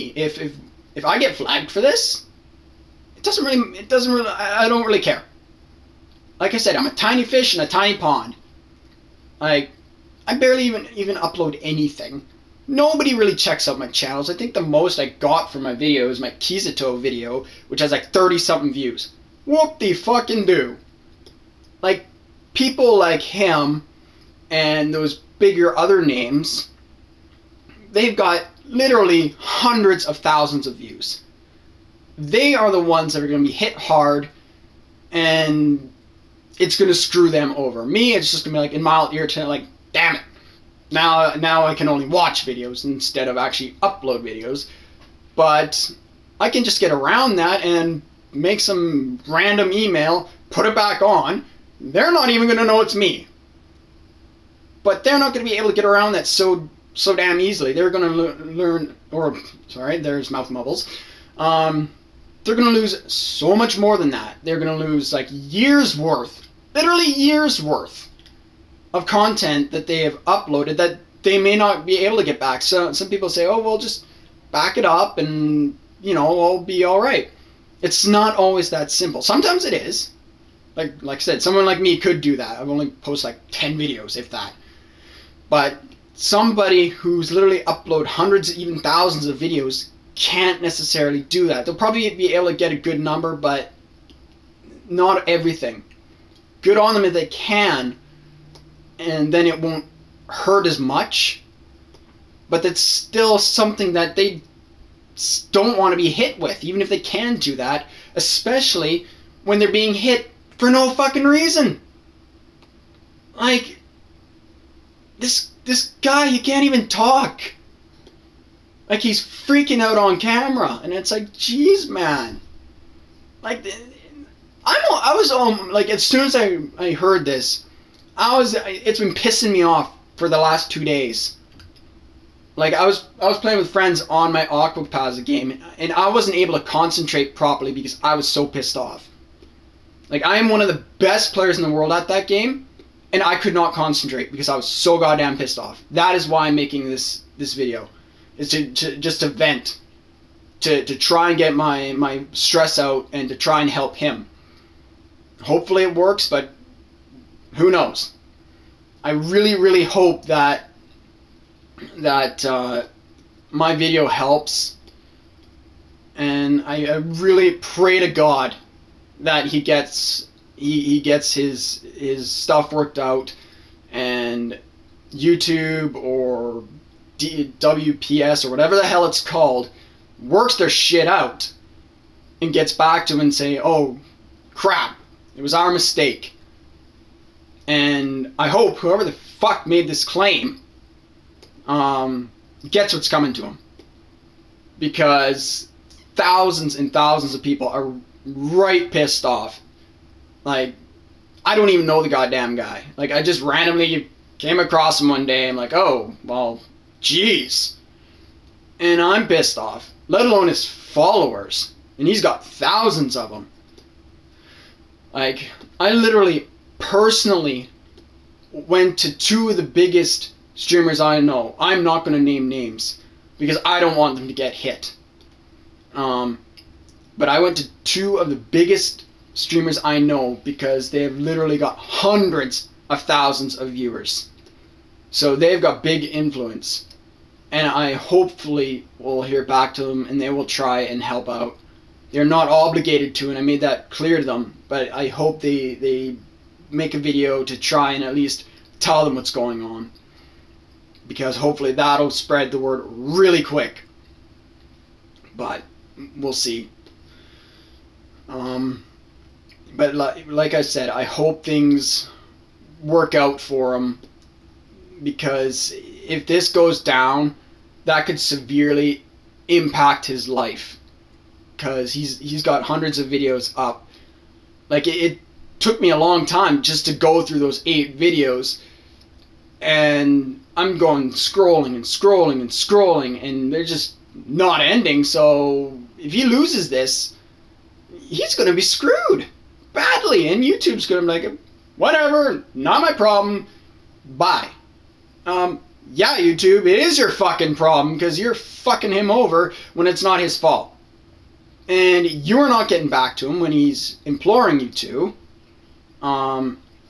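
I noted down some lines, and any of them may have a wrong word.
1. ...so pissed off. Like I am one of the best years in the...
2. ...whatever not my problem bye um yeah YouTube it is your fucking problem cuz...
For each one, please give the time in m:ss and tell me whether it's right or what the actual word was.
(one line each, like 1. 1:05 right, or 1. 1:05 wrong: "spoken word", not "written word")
1. 2:18 wrong: "players", not "years"
2. 4:51 right.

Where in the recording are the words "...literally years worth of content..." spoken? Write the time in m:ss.
1:06.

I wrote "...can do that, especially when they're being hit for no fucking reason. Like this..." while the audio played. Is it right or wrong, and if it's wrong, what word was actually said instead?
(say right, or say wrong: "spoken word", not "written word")
right.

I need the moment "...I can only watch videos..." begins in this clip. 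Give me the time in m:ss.
0:41.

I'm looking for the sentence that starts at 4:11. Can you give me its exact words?
Because hopefully that'll spread the word really quick.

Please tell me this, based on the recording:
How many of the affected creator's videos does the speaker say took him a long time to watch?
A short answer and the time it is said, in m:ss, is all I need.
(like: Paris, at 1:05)
8, at 4:37.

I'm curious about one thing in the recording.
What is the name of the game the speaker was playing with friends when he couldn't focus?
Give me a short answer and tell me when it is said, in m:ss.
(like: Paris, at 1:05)
Aquapazza, at 2:14.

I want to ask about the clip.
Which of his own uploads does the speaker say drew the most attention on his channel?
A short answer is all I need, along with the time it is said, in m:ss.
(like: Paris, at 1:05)
Kizito video, at 0:16.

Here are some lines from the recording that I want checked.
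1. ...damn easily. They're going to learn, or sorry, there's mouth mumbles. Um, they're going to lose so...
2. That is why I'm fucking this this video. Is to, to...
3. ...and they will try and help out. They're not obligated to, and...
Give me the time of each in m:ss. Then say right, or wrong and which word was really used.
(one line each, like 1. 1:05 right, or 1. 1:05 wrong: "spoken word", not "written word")
1. 0:57 right
2. 2:25 wrong: "making", not "fucking"
3. 4:00 right.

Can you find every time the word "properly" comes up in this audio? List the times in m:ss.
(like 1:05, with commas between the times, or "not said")
2:17.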